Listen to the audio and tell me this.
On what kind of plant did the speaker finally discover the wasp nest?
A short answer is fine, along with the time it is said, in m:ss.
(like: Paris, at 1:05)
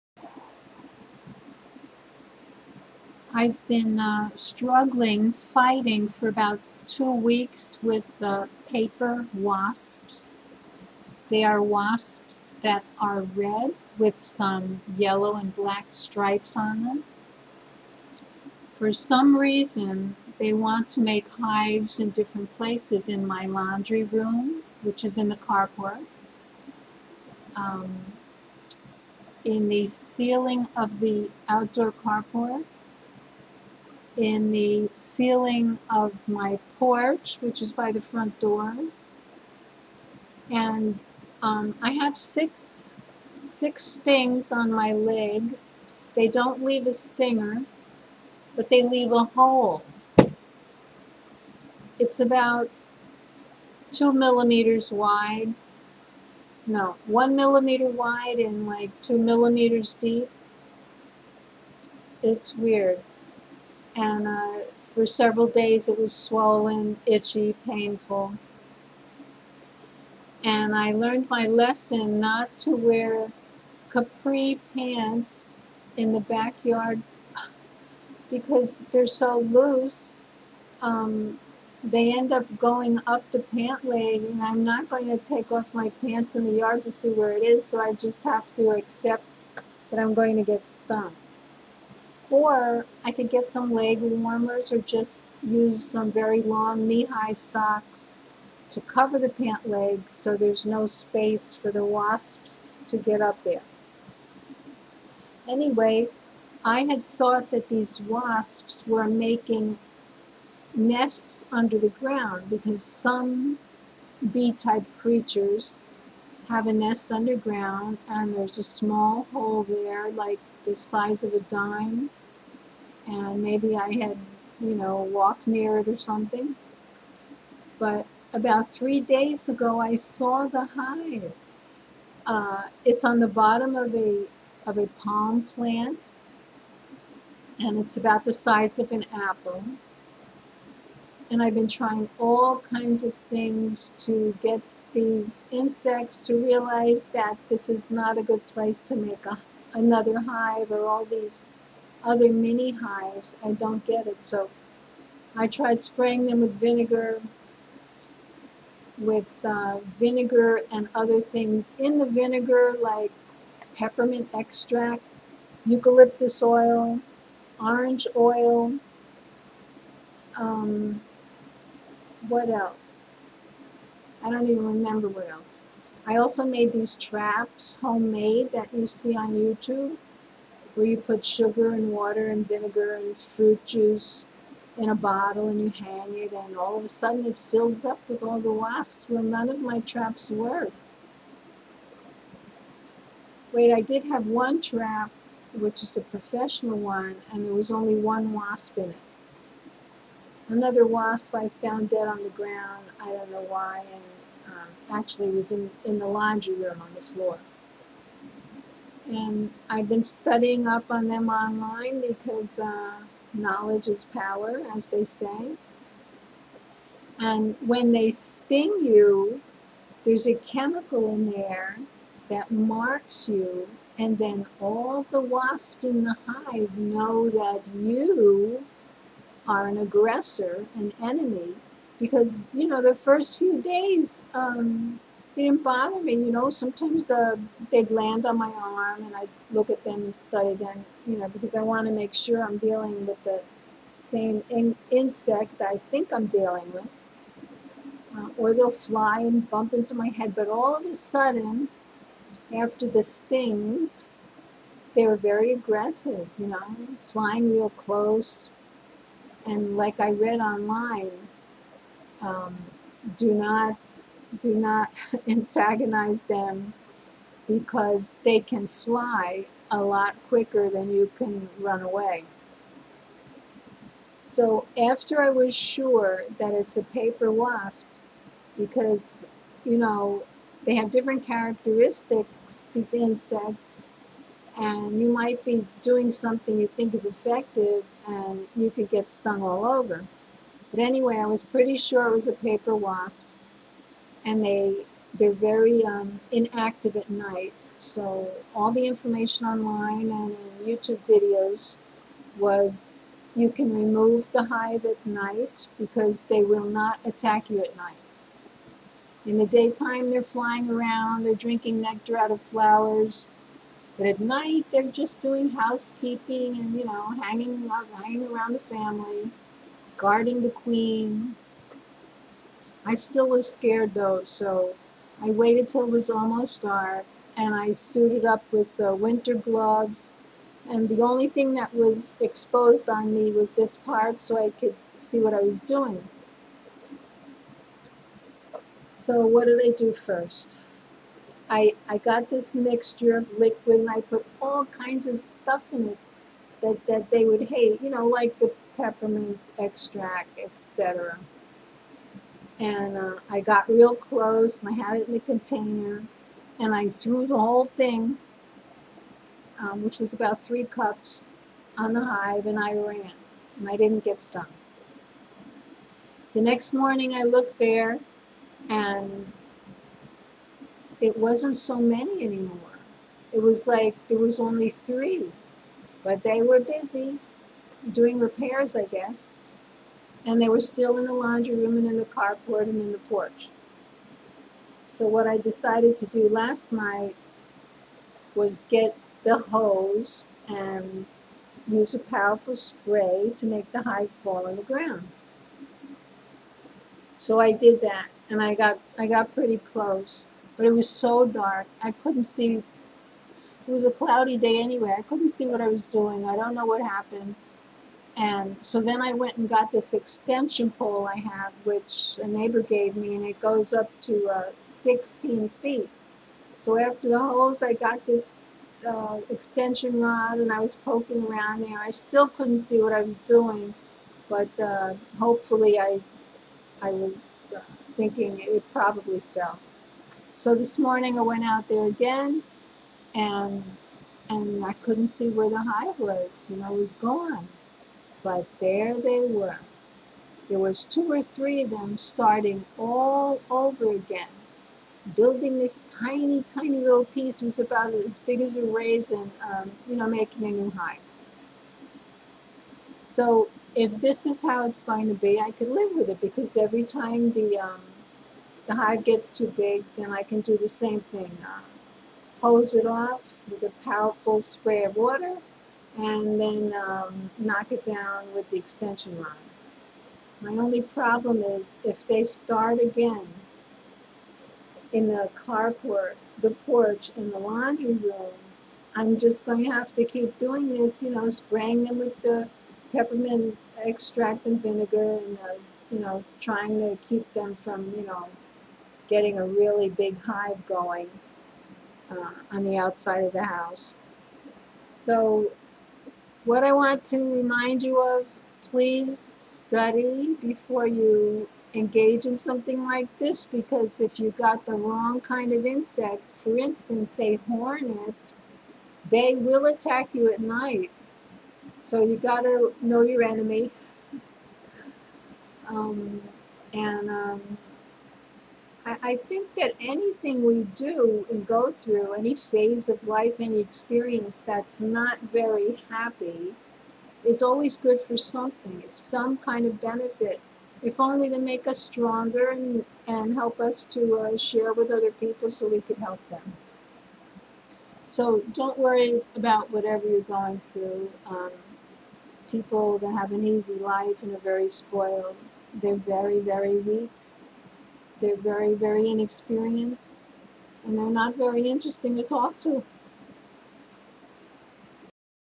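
A palm plant, at 2:14.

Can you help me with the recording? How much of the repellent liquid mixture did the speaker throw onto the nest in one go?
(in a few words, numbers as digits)
About 3 cups.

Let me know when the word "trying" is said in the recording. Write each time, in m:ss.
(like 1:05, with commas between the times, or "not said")
2:21, 8:06.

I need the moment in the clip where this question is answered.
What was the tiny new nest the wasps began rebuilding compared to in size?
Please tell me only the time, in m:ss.
7:28.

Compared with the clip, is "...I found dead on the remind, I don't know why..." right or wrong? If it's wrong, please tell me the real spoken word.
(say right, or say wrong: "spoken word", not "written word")
wrong: "ground", not "remind".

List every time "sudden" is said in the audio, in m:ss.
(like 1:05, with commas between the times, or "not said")
3:06, 4:10.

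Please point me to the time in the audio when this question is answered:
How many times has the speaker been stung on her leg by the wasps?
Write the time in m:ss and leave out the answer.
0:43.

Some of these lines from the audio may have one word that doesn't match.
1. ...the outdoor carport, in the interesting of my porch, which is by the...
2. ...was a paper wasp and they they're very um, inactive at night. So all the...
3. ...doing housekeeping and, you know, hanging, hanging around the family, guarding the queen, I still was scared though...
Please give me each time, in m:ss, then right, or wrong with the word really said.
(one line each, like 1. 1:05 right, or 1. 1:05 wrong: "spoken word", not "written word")
1. 0:30 wrong: "ceiling", not "interesting"
2. 4:52 right
3. 5:15 right.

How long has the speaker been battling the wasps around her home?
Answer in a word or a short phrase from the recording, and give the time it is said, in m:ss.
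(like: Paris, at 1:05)
About 2 weeks, at 0:06.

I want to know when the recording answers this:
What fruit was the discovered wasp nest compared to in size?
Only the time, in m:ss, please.
2:18.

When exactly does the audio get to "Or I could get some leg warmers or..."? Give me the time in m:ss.
1:32.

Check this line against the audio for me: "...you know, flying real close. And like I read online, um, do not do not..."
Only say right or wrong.
right.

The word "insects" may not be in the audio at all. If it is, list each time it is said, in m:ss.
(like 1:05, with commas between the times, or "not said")
2:25, 4:04, 4:42, 8:25.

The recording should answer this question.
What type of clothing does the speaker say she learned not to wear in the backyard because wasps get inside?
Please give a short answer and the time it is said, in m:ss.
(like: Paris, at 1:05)
Capri pants, at 1:13.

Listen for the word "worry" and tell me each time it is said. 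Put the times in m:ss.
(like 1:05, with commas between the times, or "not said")
8:58.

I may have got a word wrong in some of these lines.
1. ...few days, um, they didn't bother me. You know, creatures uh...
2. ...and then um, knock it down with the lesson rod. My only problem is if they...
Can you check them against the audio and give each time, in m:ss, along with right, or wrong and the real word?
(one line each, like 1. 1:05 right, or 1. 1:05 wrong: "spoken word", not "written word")
1. 3:53 wrong: "sometimes", not "creatures"
2. 7:45 wrong: "extension", not "lesson".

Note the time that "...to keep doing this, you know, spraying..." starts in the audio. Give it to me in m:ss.
7:59.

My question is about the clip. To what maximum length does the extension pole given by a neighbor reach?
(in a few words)
16 feet.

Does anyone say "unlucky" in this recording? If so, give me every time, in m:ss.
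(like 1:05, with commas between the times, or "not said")
not said.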